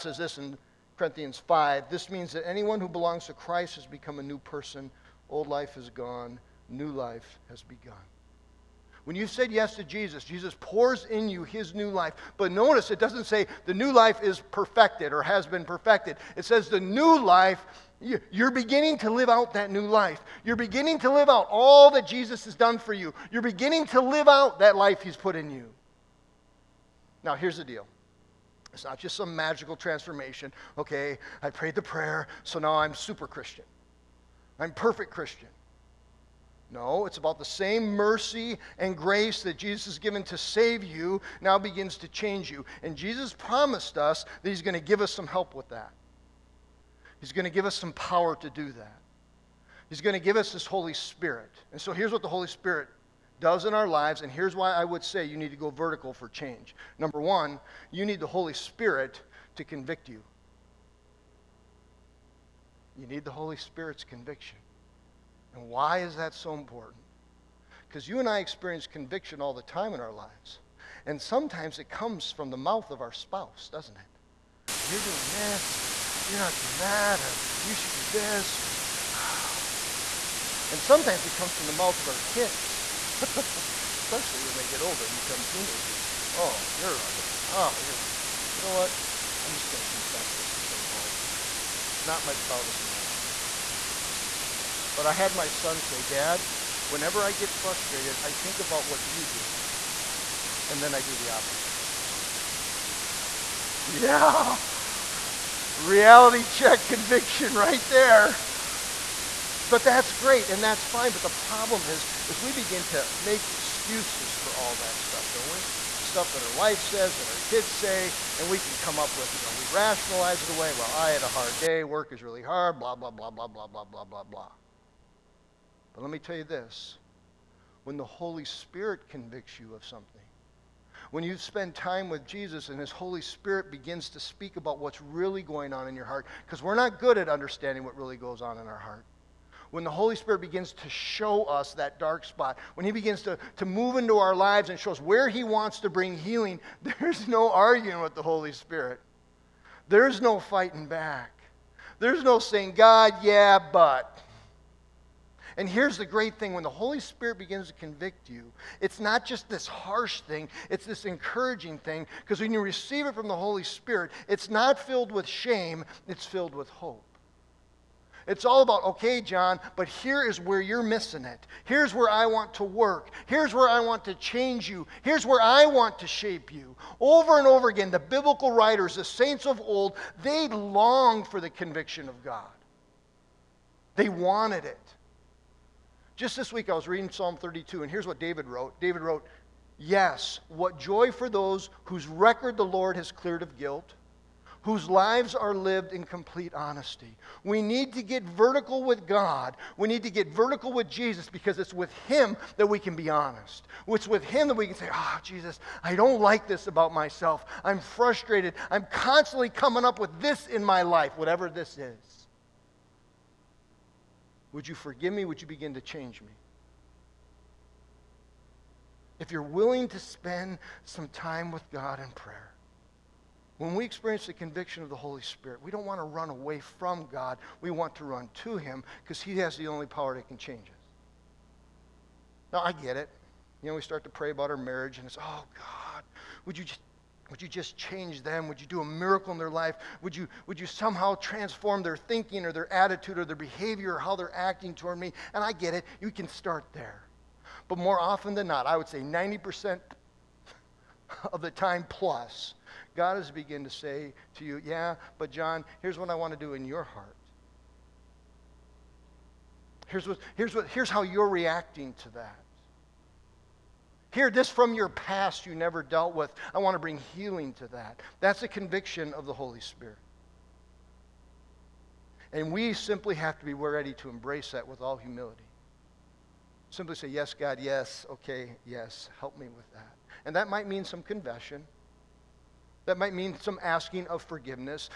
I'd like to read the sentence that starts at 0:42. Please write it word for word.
And Jesus promised us that He's going to give us some help with that.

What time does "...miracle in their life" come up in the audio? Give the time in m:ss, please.
3:58.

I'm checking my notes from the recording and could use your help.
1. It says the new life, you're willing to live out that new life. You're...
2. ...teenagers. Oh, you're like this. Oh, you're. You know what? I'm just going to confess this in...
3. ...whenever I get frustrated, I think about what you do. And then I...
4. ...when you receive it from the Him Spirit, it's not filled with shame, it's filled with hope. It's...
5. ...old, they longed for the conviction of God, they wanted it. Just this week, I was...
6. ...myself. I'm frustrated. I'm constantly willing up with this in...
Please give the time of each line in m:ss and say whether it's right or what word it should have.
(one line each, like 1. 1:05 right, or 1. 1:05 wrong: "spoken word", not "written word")
1. 0:16 wrong: "beginning", not "willing"
2. 1:25 right
3. 1:36 right
4. 2:42 wrong: "Holy", not "Him"
5. 2:59 right
6. 3:26 wrong: "coming", not "willing".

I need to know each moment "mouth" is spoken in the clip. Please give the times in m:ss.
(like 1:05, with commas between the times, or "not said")
1:12, 1:21.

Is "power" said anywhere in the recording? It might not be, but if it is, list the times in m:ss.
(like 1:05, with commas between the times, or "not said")
0:47, 3:49.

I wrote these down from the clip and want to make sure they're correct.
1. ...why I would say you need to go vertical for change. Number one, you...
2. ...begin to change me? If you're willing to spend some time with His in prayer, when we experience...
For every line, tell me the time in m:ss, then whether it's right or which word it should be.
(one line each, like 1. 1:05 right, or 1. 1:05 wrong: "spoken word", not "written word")
1. 0:54 right
2. 3:35 wrong: "God", not "His".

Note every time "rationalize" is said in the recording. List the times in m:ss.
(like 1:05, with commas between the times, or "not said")
1:59.